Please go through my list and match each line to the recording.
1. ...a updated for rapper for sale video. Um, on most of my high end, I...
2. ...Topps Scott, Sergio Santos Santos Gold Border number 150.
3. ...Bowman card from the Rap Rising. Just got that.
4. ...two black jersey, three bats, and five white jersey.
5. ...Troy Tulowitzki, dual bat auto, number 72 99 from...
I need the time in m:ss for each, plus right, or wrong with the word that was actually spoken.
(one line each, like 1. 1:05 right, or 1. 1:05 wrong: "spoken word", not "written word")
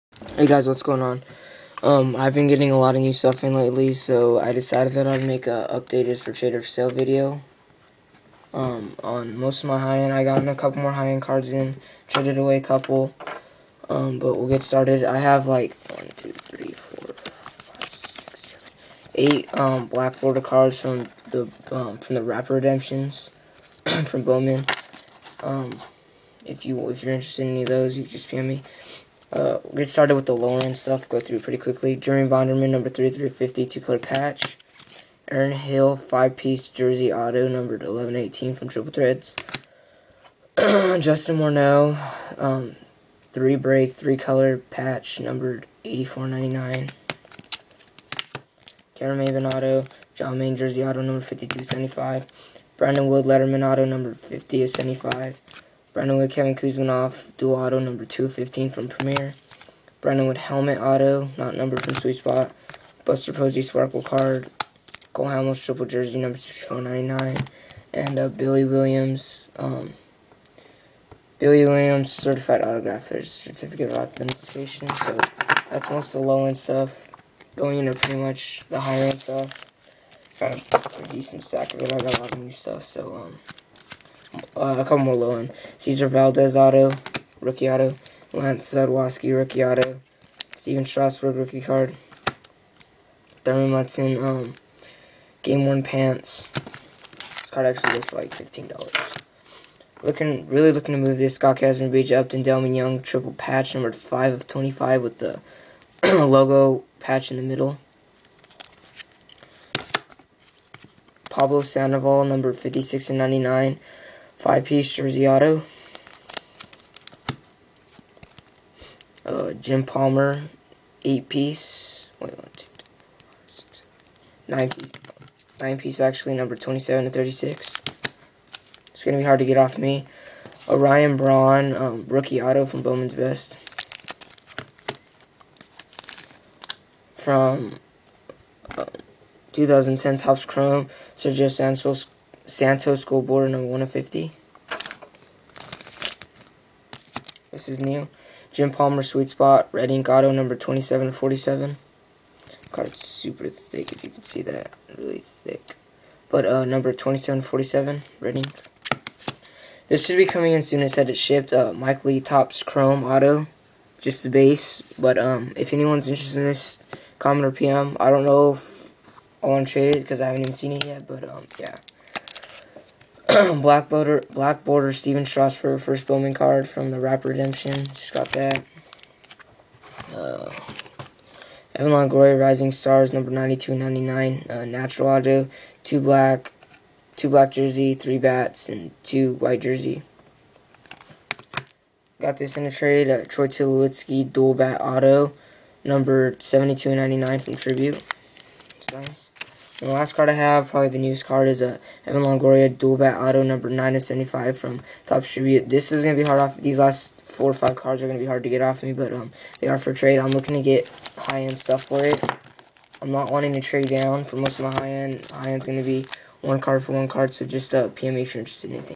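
1. 0:05 wrong: "trader", not "rapper"
2. 2:20 wrong: "Chrome", not "Scott"
3. 2:56 wrong: "Redemption", not "Rising"
4. 3:07 wrong: "two", not "five"
5. 3:13 right.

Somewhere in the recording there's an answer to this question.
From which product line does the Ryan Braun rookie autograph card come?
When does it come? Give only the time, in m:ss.
2:12.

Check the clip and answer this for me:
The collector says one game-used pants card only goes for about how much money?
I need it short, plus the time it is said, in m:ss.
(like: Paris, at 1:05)
$15, at 1:38.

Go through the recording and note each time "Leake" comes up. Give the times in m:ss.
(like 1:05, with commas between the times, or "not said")
2:42.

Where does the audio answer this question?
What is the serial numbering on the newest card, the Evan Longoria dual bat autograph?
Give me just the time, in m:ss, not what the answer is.
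3:23.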